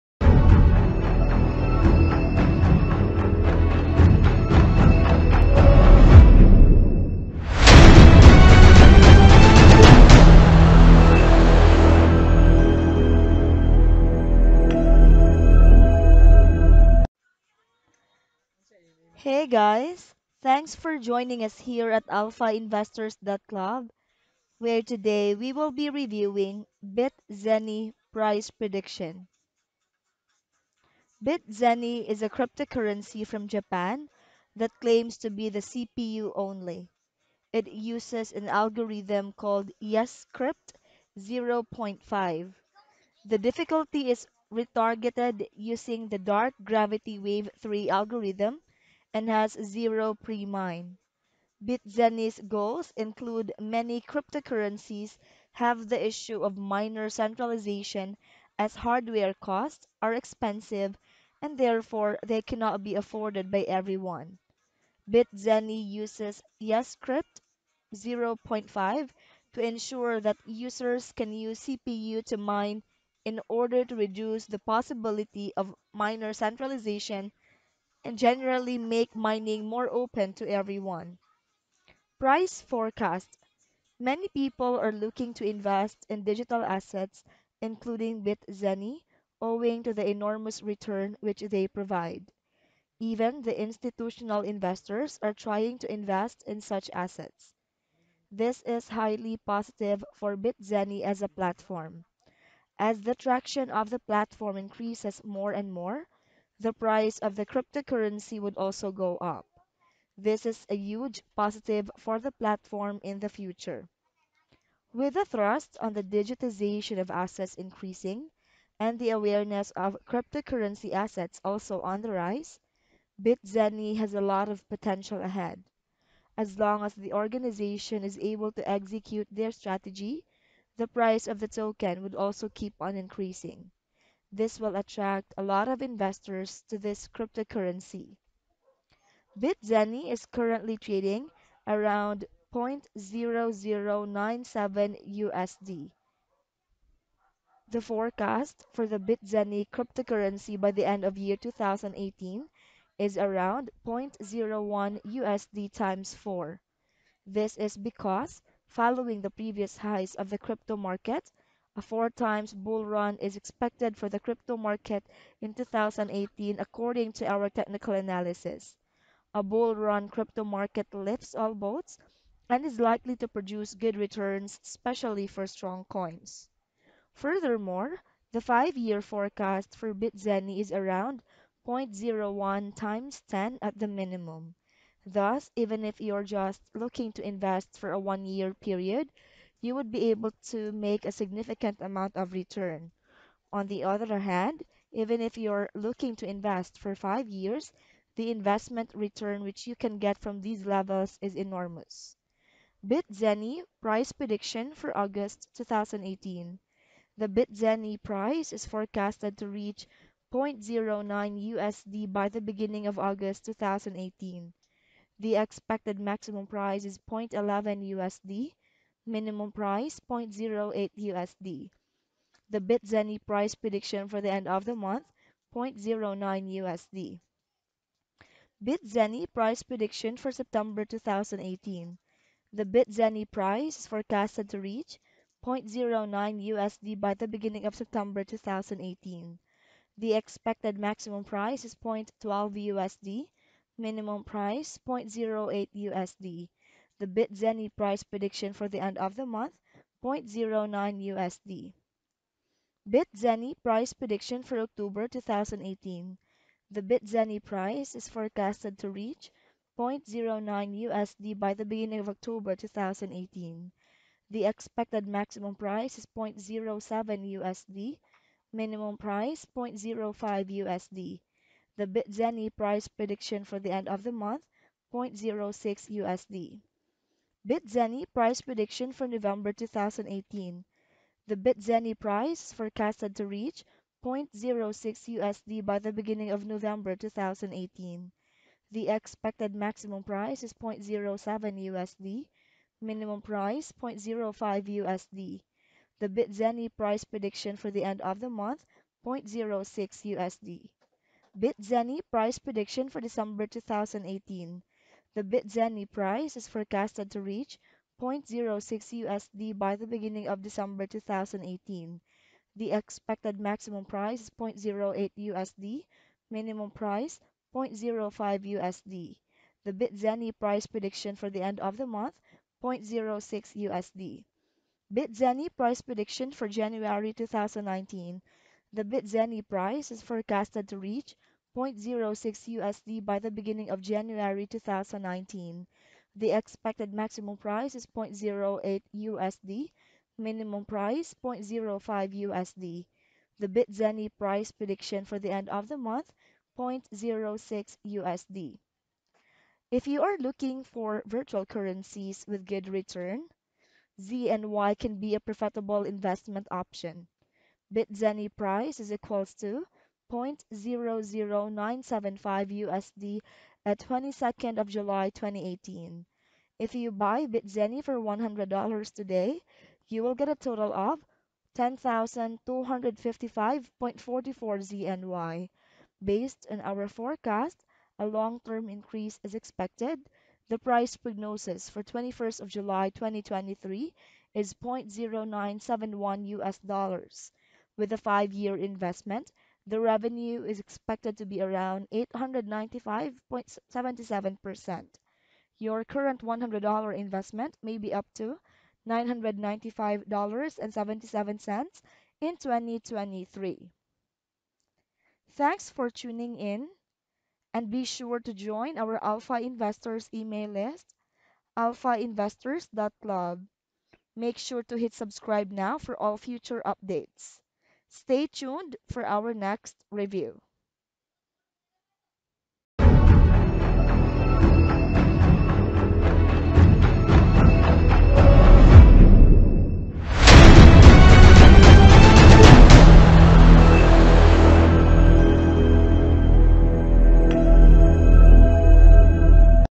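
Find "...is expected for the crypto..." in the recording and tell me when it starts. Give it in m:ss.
2:43.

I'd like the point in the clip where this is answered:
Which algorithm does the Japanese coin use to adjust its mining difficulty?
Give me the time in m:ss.
0:46.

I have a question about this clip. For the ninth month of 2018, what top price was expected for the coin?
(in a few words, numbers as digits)
0.12 USD.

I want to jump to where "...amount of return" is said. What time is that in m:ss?
3:11.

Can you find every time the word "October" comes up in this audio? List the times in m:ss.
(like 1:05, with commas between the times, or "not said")
4:14, 4:22.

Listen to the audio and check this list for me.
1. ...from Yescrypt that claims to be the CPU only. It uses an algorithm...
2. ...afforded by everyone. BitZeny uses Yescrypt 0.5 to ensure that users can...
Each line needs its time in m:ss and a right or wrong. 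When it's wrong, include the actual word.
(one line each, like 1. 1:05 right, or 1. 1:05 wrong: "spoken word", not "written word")
1. 0:33 wrong: "Japan", not "Yescrypt"
2. 1:02 right.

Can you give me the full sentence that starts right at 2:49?
A bull run crypto market lifts all boats and is likely to produce good returns, especially for strong coins.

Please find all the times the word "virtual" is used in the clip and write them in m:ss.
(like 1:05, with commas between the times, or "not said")
5:51.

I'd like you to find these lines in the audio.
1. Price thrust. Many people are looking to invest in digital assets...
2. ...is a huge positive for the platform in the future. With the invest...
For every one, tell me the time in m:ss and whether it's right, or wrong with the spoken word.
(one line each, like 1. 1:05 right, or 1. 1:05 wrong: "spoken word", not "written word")
1. 1:22 wrong: "forecast", not "thrust"
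2. 1:50 wrong: "thrust", not "invest".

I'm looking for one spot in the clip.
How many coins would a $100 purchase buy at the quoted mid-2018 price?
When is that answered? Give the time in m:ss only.
6:11.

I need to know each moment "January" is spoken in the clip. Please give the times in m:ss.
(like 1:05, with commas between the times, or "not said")
5:26, 5:33.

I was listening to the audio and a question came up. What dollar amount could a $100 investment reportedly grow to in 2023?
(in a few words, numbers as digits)
$995.77.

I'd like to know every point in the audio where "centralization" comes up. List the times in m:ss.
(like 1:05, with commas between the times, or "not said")
0:57, 1:16.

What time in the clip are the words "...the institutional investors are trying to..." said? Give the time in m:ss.
1:33.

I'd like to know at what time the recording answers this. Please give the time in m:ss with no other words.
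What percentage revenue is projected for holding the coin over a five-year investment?
6:31.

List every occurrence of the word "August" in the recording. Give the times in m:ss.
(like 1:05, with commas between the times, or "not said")
3:24, 3:32.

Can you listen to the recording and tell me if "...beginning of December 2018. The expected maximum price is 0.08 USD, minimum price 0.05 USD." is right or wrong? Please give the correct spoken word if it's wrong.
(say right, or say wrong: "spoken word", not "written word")
right.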